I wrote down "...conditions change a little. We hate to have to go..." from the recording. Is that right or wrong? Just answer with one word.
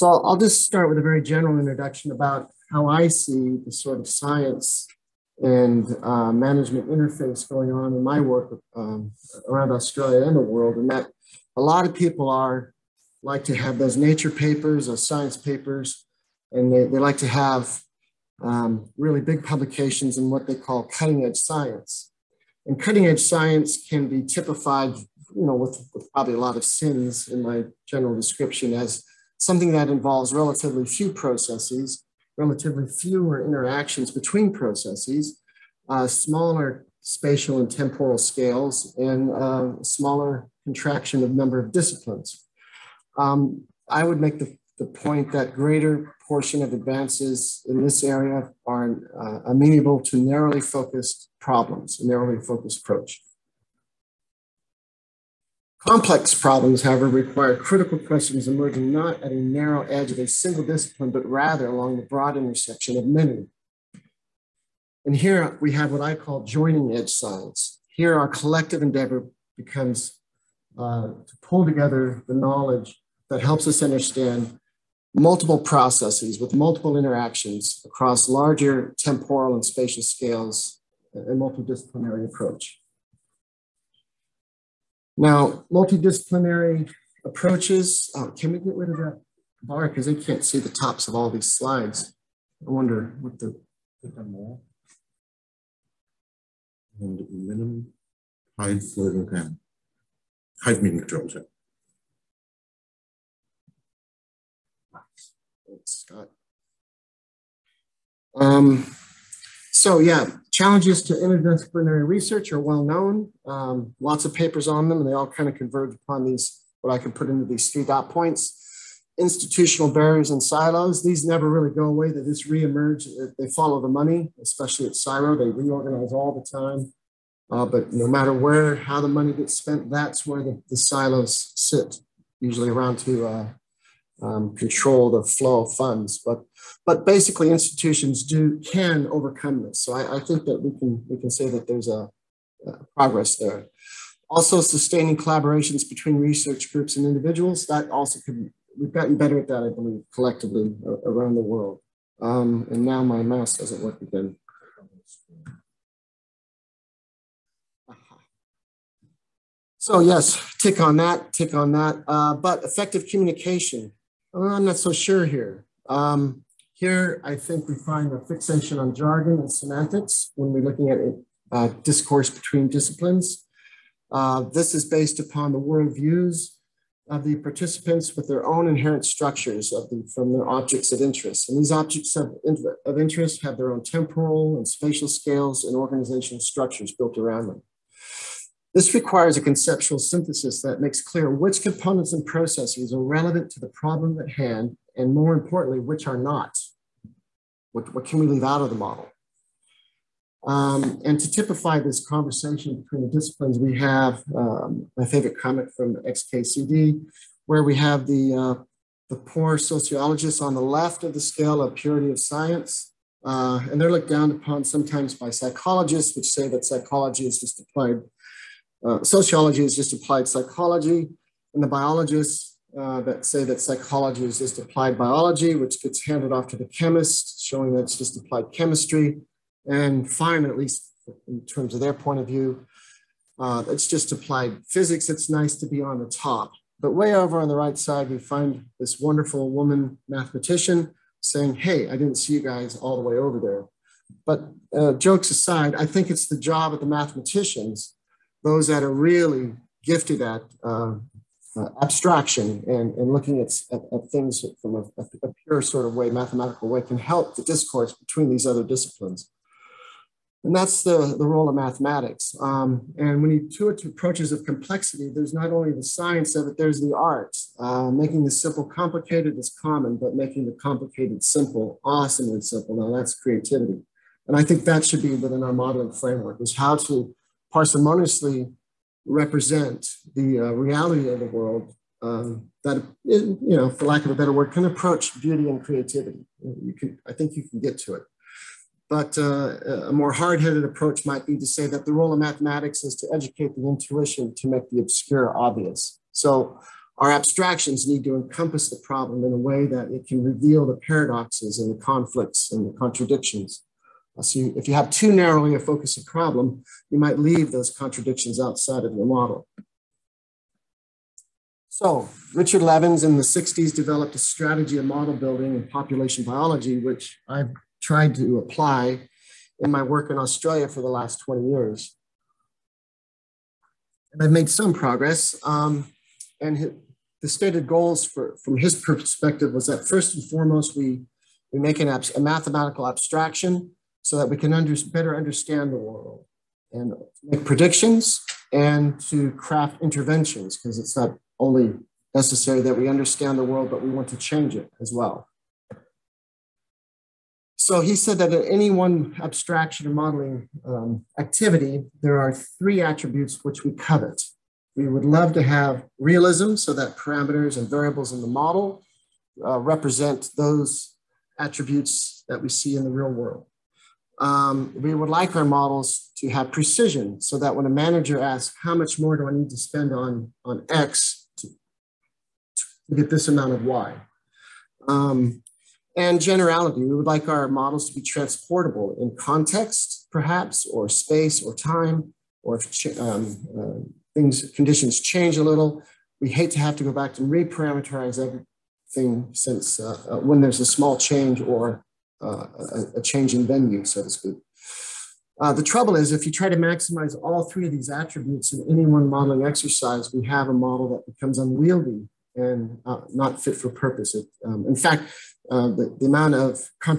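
right.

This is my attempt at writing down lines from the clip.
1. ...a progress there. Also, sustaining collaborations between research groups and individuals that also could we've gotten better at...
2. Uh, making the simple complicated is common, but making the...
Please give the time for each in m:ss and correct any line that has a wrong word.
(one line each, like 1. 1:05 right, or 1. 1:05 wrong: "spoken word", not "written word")
1. 2:22 right
2. 4:27 right.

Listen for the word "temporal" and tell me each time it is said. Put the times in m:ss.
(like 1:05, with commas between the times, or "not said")
0:37, 1:18, 3:03.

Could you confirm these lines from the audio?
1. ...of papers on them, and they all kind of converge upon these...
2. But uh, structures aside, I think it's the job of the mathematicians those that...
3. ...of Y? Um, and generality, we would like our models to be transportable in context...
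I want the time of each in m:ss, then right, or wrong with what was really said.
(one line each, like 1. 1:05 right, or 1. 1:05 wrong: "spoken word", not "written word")
1. 1:54 right
2. 4:04 wrong: "jokes", not "structures"
3. 6:13 right.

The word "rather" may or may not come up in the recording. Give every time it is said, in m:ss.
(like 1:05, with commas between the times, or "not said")
1:01.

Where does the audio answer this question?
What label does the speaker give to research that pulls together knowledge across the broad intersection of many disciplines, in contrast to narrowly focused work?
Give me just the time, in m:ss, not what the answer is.
1:06.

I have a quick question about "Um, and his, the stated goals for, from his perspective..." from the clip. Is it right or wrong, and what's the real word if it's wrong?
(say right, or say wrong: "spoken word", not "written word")
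right.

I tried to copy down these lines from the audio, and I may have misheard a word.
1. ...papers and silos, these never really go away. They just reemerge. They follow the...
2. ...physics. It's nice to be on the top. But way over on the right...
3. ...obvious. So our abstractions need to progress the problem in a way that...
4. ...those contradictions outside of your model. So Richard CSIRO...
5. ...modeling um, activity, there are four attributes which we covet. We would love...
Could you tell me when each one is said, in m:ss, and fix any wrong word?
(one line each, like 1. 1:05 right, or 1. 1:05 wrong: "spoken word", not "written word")
1. 1:59 wrong: "barriers", not "papers"
2. 3:54 right
3. 4:55 wrong: "encompass", not "progress"
4. 5:07 wrong: "Levins", not "CSIRO"
5. 5:49 wrong: "three", not "four".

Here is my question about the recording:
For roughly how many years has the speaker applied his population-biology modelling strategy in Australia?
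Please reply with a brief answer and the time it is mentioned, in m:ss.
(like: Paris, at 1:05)
20 years, at 5:21.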